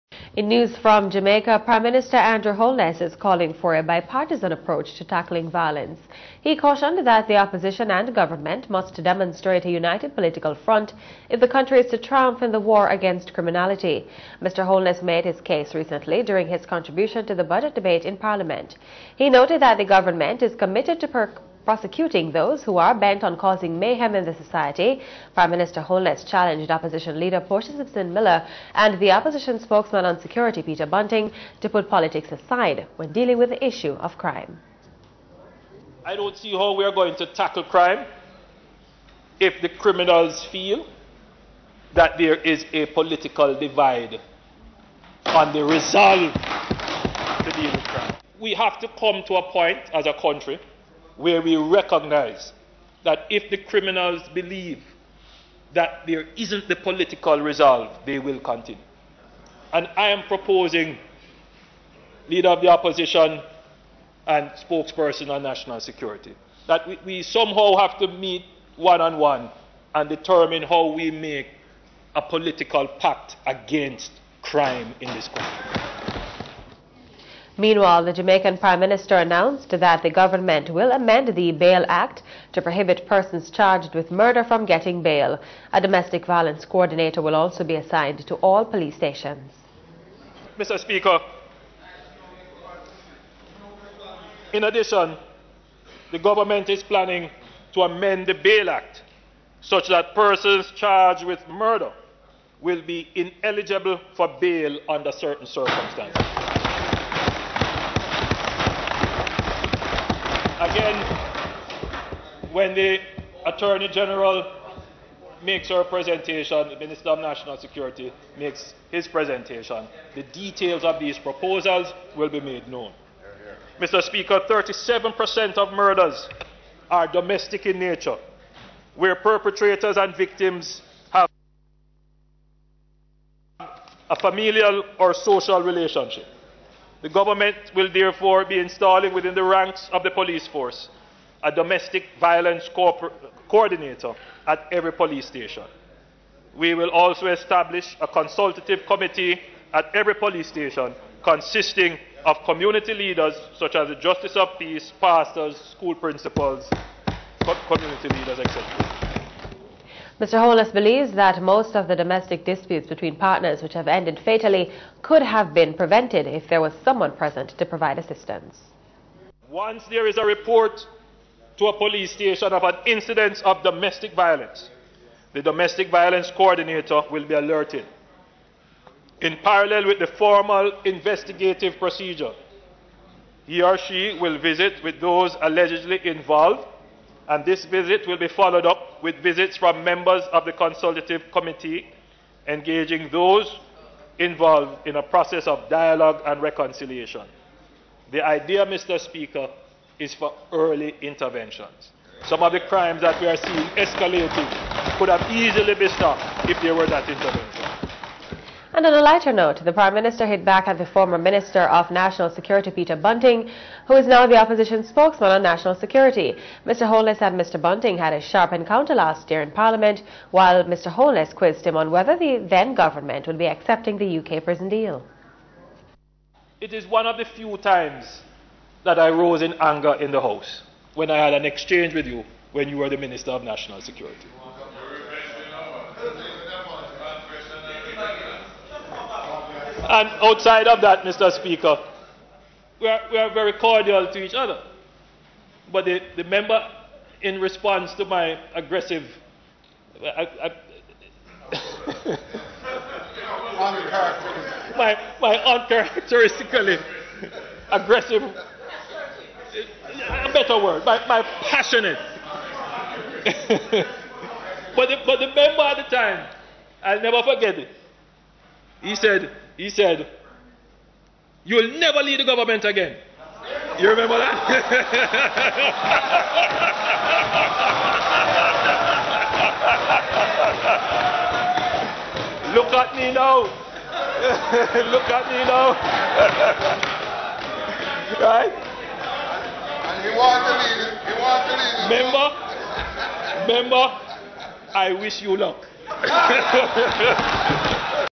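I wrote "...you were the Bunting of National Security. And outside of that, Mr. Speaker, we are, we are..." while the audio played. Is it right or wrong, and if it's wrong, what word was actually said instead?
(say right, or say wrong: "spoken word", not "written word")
wrong: "Minister", not "Bunting".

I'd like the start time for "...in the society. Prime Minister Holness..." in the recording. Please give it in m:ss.
0:24.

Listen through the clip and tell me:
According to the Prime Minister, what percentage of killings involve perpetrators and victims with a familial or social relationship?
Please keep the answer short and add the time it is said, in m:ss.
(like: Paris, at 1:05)
37%, at 2:04.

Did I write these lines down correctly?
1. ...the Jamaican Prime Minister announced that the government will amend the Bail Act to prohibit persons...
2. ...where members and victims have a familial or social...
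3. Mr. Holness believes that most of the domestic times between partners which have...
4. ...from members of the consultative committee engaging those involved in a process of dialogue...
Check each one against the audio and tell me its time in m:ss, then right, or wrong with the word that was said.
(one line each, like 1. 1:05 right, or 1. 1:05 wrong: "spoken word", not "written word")
1. 1:18 right
2. 2:08 wrong: "perpetrators", not "members"
3. 2:40 wrong: "disputes", not "times"
4. 3:09 right.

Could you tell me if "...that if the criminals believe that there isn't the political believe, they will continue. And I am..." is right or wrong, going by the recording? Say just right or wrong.
wrong.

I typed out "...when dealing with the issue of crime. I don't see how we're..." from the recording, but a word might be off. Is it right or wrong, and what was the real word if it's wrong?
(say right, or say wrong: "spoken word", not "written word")
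right.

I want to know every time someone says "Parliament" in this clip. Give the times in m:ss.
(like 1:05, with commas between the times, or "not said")
0:18, 3:39.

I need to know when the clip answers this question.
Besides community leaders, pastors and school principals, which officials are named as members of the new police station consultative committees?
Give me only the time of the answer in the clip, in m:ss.
2:33.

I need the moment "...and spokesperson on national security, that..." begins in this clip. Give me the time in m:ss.
1:04.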